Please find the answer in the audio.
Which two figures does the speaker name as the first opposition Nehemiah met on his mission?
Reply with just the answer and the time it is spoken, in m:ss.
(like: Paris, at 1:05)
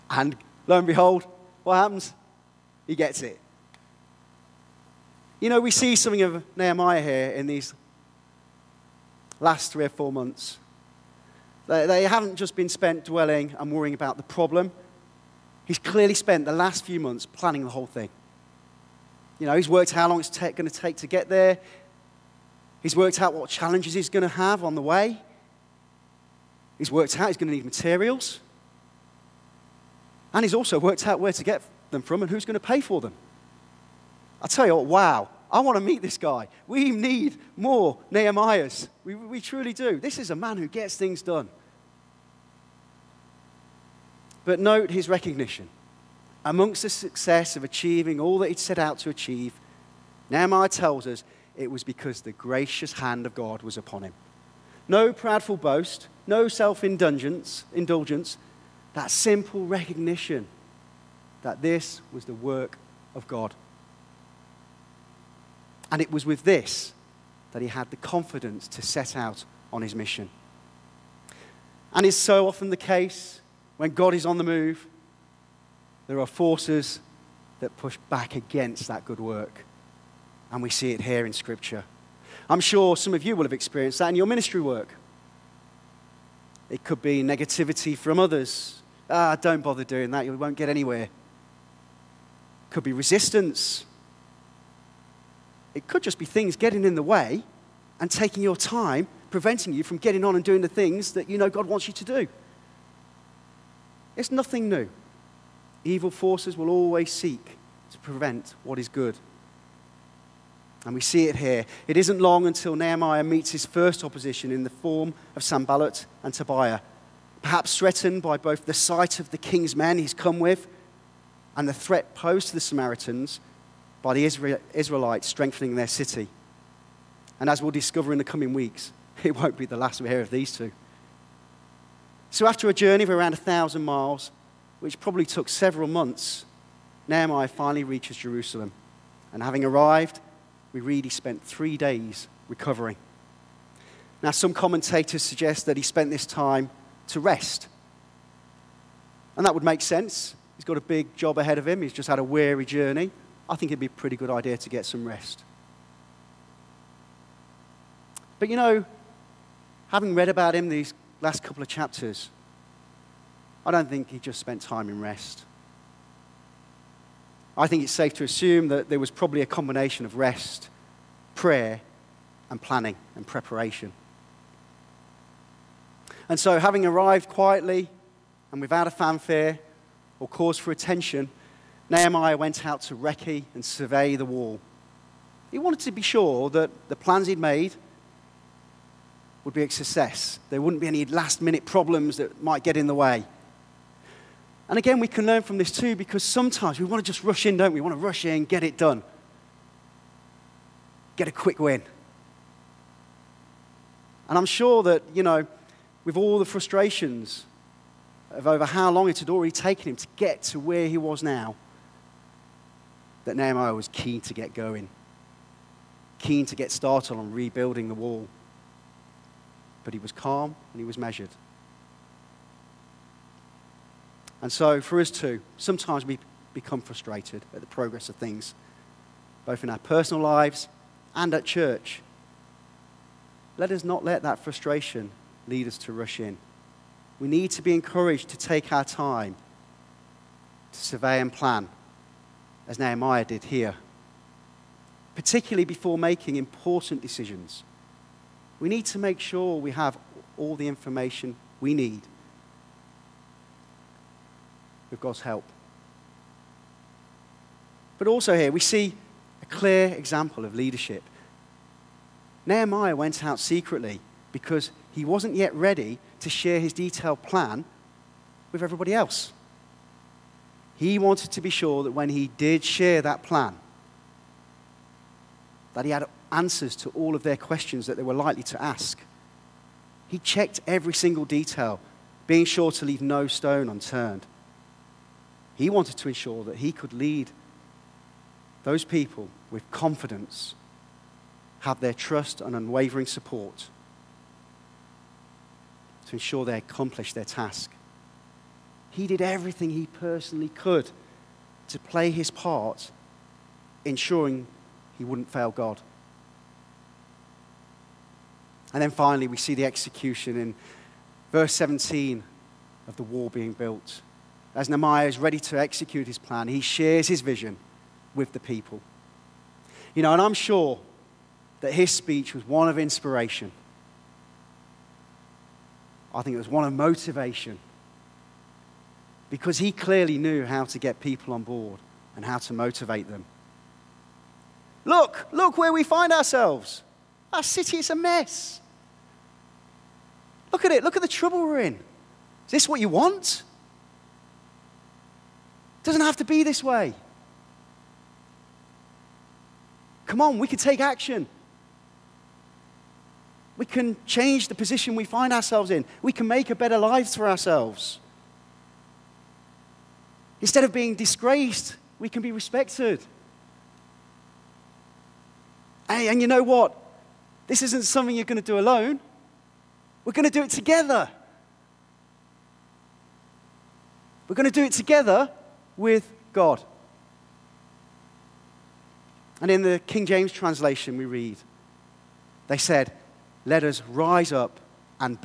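Sanballat and Tobiah, at 1:55.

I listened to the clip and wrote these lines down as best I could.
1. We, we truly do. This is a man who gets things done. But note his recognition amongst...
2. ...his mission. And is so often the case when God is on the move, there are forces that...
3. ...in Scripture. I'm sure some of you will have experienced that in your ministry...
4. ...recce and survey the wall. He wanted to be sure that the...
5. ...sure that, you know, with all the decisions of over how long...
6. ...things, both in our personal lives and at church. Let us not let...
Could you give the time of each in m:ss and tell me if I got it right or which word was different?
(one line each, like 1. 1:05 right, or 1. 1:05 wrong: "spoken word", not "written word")
1. 0:39 right
2. 1:09 right
3. 1:21 right
4. 3:02 right
5. 3:24 wrong: "frustrations", not "decisions"
6. 3:48 right.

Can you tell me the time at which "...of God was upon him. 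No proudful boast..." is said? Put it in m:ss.
0:53.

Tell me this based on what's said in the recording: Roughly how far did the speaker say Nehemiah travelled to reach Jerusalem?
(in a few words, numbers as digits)
1000 miles.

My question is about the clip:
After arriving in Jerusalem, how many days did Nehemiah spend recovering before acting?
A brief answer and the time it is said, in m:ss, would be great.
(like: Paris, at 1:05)
3, at 2:21.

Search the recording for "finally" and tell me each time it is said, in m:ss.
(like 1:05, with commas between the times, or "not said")
2:17, 5:08.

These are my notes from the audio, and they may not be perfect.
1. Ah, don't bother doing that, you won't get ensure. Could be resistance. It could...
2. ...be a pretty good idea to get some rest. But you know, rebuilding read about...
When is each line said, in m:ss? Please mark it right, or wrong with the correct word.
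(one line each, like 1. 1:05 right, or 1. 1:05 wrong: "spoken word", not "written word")
1. 1:29 wrong: "anywhere", not "ensure"
2. 2:33 wrong: "having", not "rebuilding".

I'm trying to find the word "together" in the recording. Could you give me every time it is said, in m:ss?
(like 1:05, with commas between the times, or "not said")
6:10, 6:14.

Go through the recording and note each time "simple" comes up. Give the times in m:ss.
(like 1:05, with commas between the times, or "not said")
0:59.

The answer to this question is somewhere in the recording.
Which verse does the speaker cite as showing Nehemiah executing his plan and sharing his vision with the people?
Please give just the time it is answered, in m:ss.
5:11.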